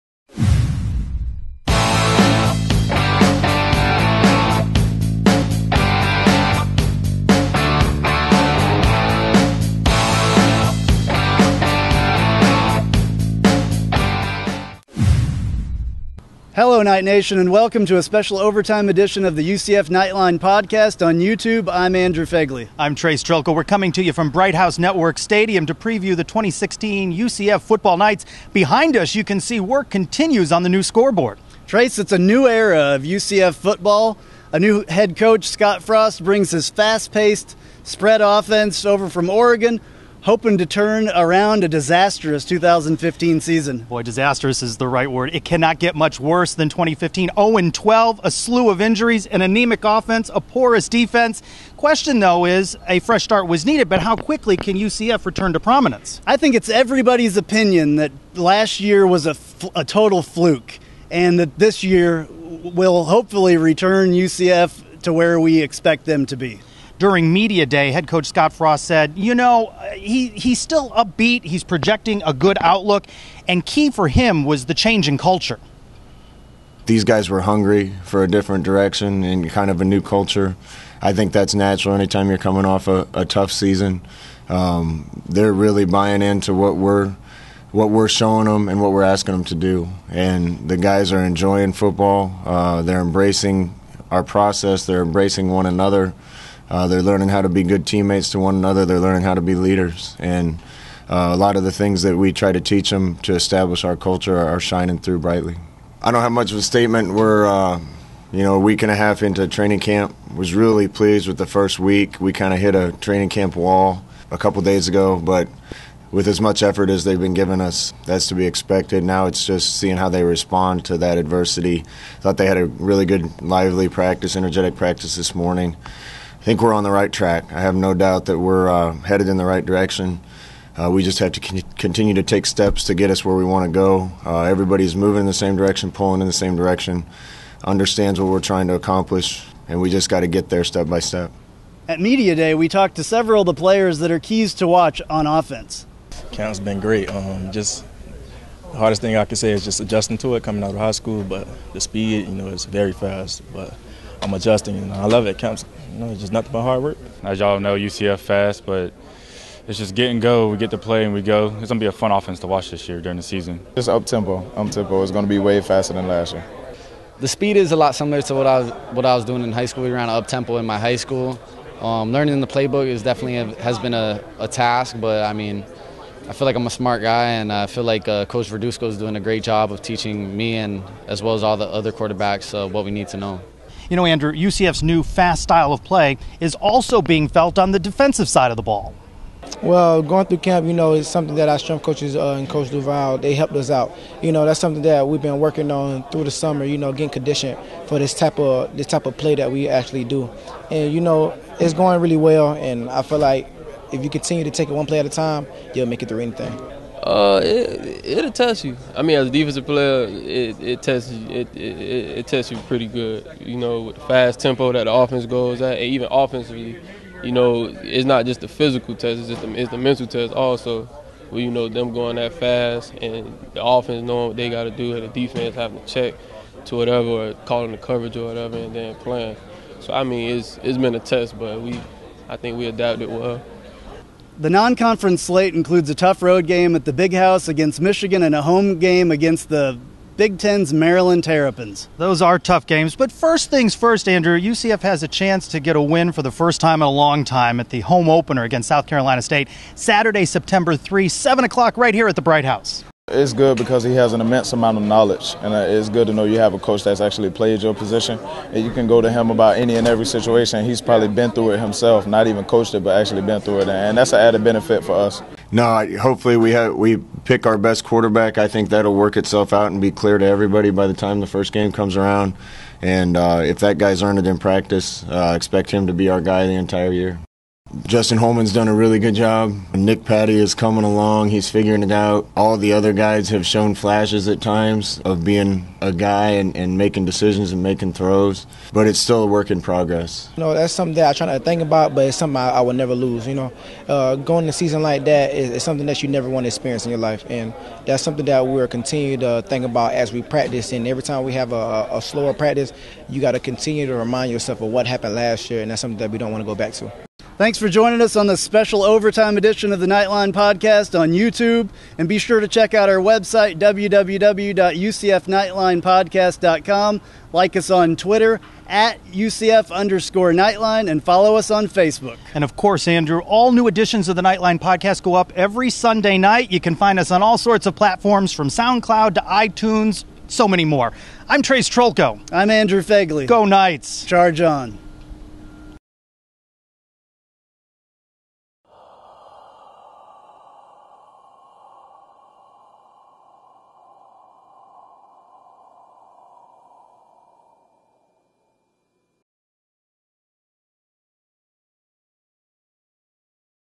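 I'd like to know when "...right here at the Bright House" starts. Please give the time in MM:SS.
04:11.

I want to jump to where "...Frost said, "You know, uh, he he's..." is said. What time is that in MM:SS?
01:08.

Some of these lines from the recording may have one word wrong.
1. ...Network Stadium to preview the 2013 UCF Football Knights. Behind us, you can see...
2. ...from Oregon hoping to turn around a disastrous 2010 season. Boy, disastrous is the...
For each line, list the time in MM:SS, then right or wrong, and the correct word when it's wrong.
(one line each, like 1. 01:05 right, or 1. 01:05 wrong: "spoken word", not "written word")
1. 00:24 wrong: "2016", not "2013"
2. 00:39 wrong: "2015", not "2010".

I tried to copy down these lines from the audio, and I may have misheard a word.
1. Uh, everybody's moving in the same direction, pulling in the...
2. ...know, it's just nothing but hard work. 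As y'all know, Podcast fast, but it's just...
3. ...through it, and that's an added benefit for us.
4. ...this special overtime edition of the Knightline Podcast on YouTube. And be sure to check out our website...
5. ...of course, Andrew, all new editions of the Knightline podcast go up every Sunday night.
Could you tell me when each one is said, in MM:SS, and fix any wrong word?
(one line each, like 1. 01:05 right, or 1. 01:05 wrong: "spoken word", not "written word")
1. 02:14 right
2. 02:35 wrong: "UCF", not "Podcast"
3. 04:23 right
4. 05:08 right
5. 05:22 right.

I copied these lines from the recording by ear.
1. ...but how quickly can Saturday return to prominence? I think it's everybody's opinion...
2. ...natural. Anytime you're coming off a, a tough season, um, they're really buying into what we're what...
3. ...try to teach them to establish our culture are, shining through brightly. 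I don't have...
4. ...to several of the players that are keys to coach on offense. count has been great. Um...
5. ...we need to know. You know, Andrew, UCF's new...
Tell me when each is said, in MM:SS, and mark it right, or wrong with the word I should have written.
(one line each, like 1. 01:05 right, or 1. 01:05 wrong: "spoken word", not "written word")
1. 00:53 wrong: "UCF", not "Saturday"
2. 01:21 right
3. 01:42 right
4. 02:22 wrong: "watch", not "coach"
5. 03:02 right.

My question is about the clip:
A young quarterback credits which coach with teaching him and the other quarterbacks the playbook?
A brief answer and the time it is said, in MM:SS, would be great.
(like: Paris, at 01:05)
Coach Verduzco, at 02:58.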